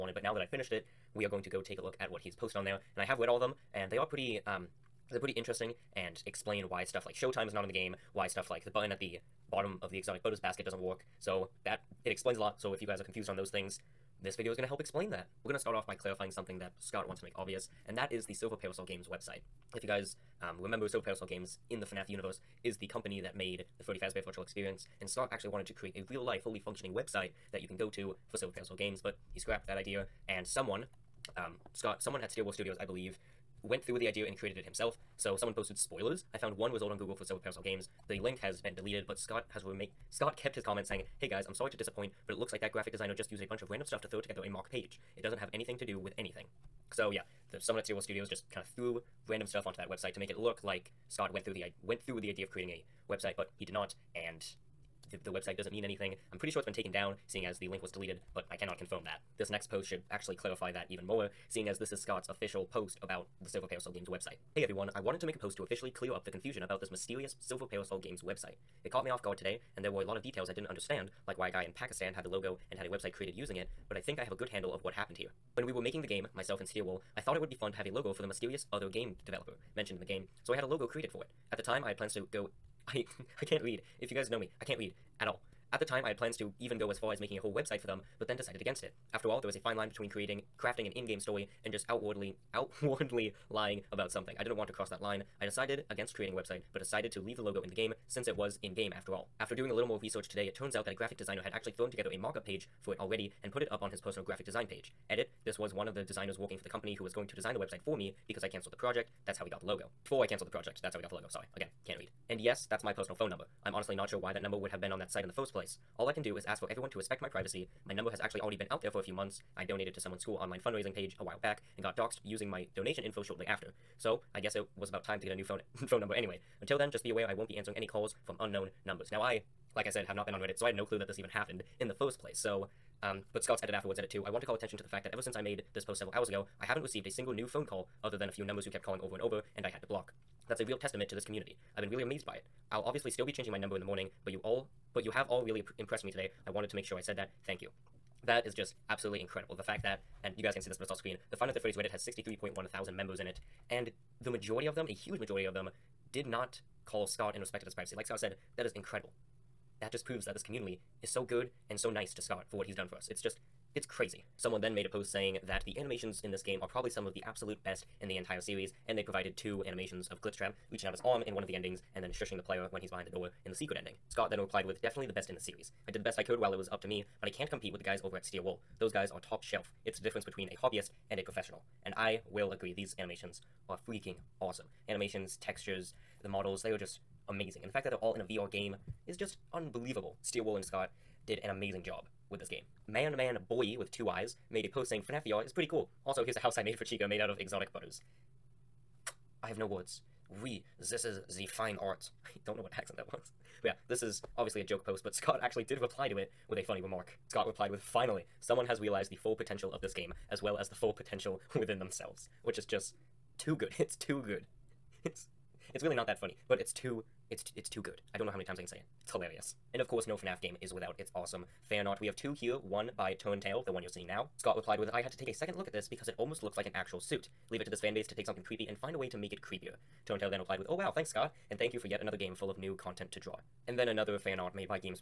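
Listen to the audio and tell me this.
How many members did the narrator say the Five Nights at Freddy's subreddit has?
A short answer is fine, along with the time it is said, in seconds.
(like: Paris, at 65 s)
63.1 thousand, at 151 s.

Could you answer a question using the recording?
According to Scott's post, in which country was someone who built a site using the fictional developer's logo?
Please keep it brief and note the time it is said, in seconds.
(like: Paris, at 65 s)
Pakistan, at 71 s.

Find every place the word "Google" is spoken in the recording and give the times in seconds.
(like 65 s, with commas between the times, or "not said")
36 s.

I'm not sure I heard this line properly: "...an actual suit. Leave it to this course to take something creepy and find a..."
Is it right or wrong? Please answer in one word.
wrong.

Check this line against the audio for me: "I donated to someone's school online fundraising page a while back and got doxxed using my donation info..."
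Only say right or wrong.
right.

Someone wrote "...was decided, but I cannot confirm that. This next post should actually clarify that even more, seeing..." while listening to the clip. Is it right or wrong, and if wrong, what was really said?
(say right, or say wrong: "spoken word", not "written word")
wrong: "deleted", not "decided".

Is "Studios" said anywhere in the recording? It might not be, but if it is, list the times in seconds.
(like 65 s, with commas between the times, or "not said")
32 s, 48 s.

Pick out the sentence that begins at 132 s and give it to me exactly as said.
So, um, but Scott's edit afterwards, edit too.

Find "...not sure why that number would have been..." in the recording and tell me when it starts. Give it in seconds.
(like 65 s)
113 s.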